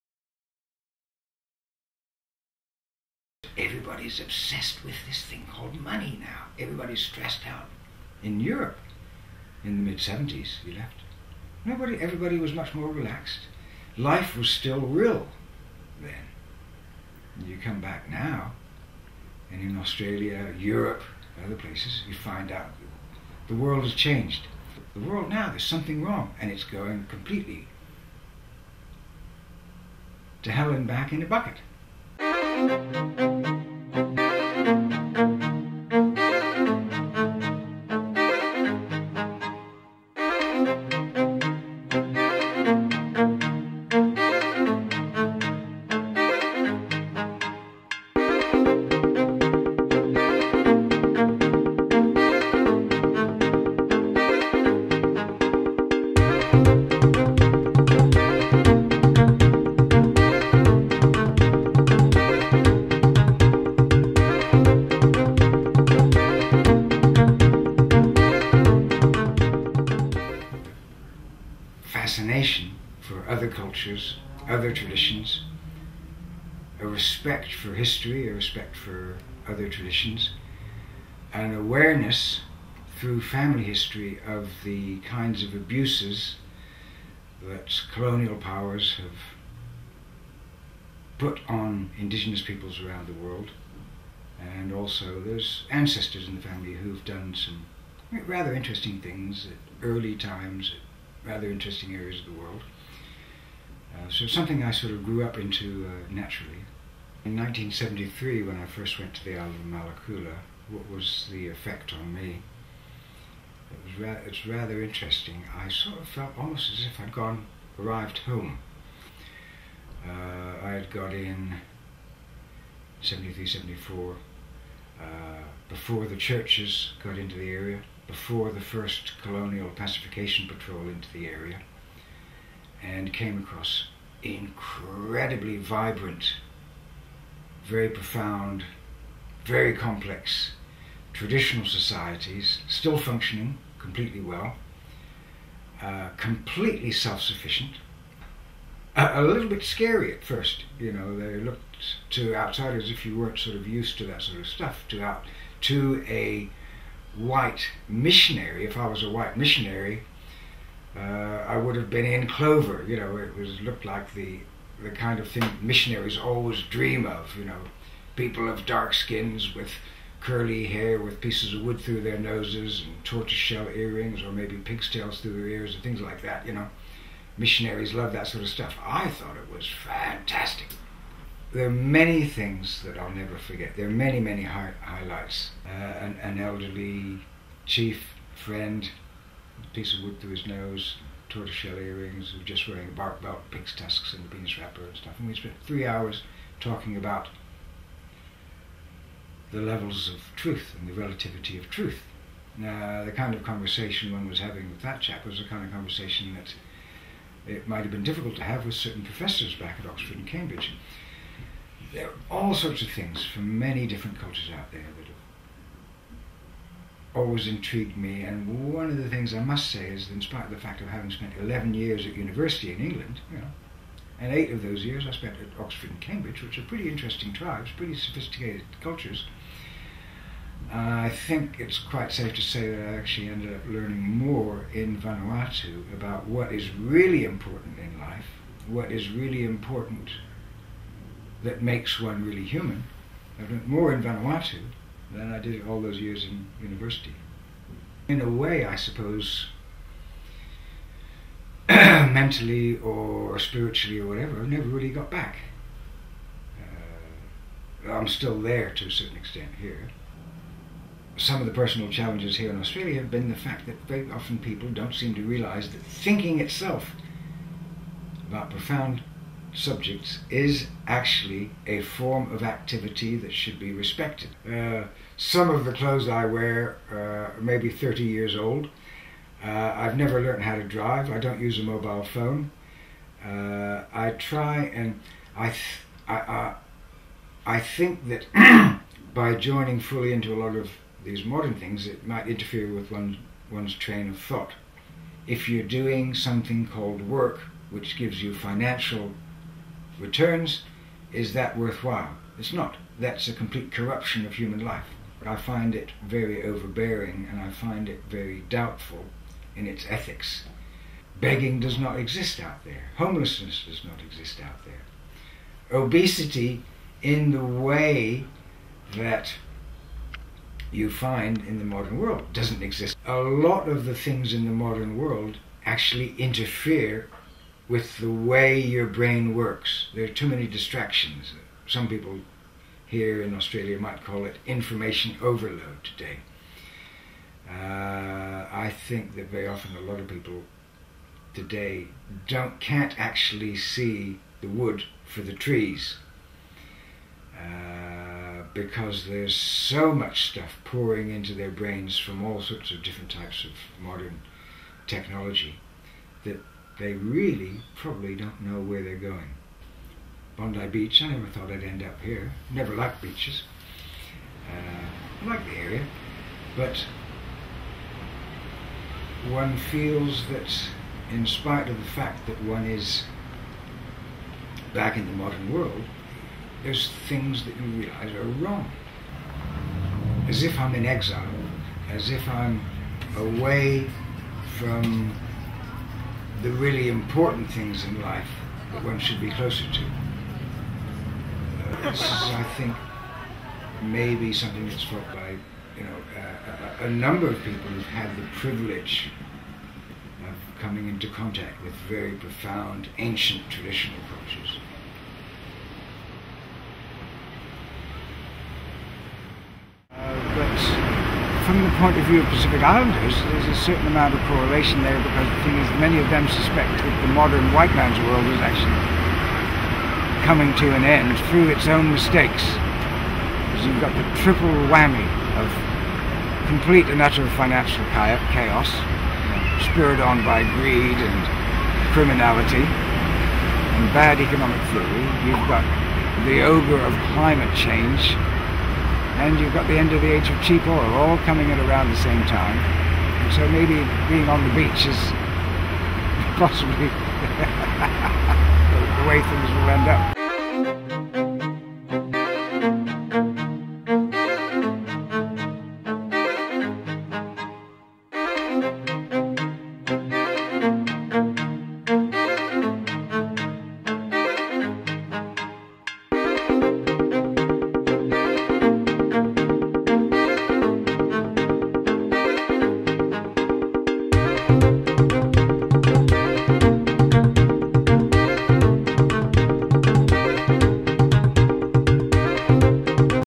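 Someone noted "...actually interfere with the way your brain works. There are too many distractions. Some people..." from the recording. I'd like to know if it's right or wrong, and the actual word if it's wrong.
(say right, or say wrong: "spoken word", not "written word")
right.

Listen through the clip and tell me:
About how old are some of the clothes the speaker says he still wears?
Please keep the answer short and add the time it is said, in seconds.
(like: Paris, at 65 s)
30 years, at 277 s.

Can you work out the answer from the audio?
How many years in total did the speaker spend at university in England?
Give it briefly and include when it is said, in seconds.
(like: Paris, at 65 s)
11, at 221 s.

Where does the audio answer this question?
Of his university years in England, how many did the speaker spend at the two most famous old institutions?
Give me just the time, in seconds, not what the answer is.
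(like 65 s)
224 s.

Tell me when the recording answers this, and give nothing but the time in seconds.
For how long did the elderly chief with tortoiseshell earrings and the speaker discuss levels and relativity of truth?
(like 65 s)
195 s.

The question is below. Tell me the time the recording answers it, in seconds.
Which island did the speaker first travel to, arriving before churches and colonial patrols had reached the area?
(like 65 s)
109 s.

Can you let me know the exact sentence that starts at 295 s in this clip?
If you're doing something called work, which gives you financial returns, is that worthwhile?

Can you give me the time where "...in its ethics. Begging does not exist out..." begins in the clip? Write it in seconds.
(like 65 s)
309 s.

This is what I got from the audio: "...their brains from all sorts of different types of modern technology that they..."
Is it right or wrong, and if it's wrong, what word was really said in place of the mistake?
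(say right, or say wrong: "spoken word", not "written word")
right.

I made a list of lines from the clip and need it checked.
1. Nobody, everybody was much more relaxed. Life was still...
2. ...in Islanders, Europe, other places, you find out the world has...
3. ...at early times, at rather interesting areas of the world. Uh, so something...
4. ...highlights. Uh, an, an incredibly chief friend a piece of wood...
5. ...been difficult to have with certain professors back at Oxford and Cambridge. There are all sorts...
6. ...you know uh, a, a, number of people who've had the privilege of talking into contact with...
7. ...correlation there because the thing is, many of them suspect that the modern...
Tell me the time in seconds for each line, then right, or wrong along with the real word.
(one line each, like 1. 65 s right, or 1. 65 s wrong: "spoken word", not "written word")
1. 11 s right
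2. 19 s wrong: "Australia", not "Islanders"
3. 99 s right
4. 184 s wrong: "elderly", not "incredibly"
5. 207 s right
6. 395 s wrong: "coming", not "talking"
7. 414 s right.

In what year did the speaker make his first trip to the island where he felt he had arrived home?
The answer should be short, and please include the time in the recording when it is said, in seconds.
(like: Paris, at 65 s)
1973, at 107 s.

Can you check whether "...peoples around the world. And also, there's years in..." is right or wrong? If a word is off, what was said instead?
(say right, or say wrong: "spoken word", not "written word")
wrong: "ancestors", not "years".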